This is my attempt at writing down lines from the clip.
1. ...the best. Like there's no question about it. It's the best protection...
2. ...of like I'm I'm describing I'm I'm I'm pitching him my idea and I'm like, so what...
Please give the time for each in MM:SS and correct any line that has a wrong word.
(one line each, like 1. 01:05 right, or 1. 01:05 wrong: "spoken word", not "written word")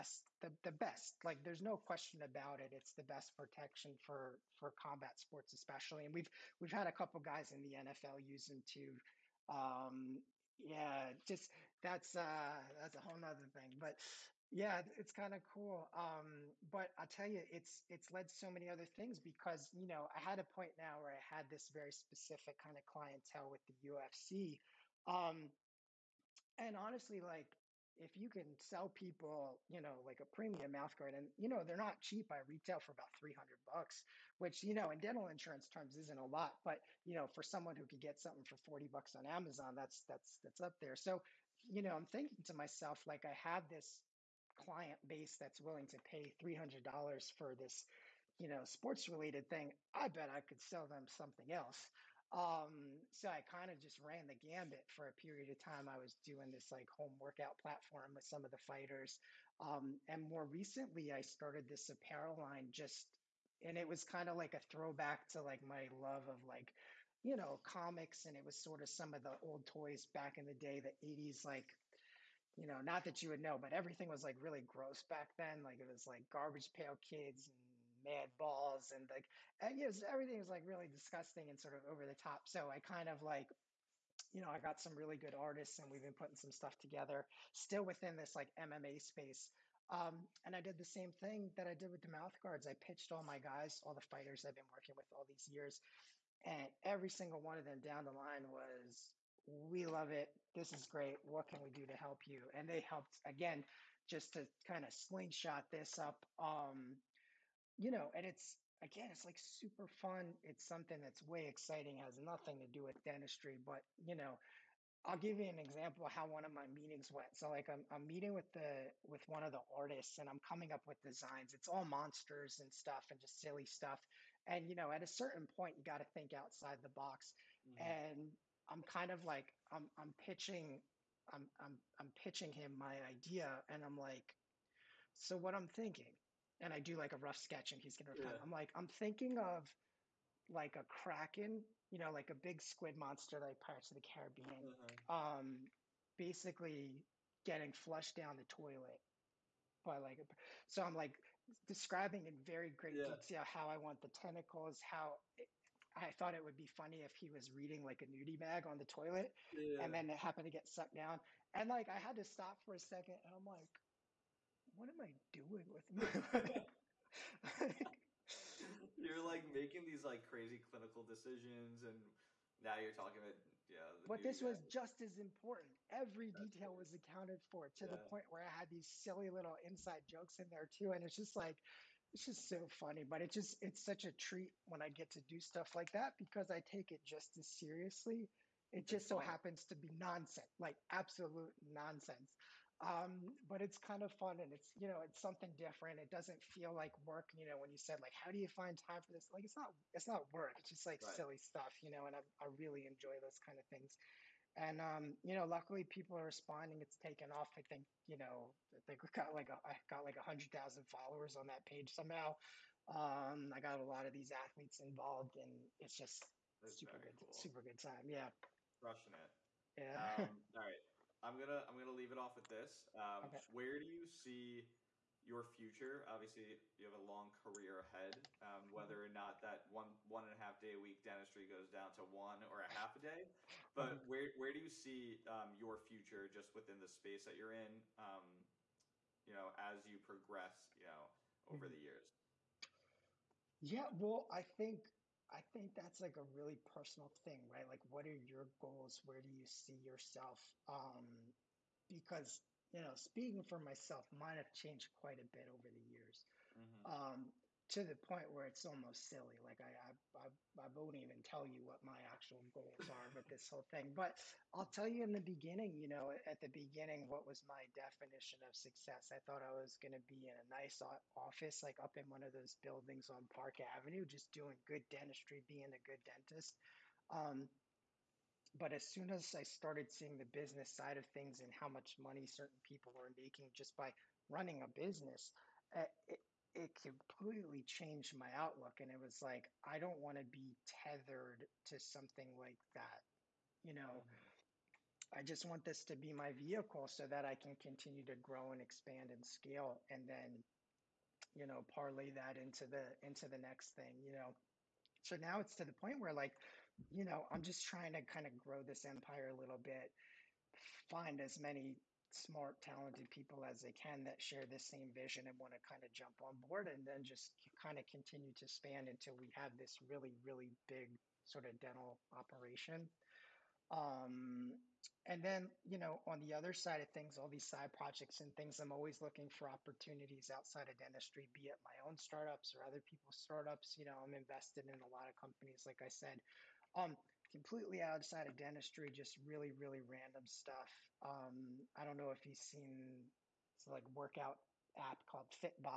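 1. 00:00 right
2. 02:09 wrong: "pitching", not "describing".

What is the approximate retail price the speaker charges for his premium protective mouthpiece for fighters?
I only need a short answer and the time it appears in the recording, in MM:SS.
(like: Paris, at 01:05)
$300, at 00:33.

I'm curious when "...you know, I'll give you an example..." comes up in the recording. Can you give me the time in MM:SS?
01:54.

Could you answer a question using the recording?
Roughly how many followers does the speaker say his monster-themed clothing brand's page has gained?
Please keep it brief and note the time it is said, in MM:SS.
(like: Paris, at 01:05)
100,000, at 03:30.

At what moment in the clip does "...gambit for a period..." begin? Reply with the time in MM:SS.
00:54.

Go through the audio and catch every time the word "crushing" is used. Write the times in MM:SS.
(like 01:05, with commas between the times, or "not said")
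03:38.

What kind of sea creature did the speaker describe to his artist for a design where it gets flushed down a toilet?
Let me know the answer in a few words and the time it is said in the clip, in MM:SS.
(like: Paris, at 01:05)
Kraken, at 02:20.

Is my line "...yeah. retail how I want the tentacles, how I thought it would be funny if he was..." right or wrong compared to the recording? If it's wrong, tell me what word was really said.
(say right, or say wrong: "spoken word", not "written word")
wrong: "detail", not "retail".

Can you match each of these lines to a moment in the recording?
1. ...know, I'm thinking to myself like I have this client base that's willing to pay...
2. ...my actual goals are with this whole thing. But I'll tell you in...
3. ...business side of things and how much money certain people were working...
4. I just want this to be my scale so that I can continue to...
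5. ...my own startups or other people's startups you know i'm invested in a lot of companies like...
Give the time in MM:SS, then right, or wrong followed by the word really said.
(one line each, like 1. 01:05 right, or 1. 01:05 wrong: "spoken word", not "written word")
1. 00:41 right
2. 04:21 right
3. 04:40 wrong: "making", not "working"
4. 04:55 wrong: "vehicle", not "scale"
5. 05:31 right.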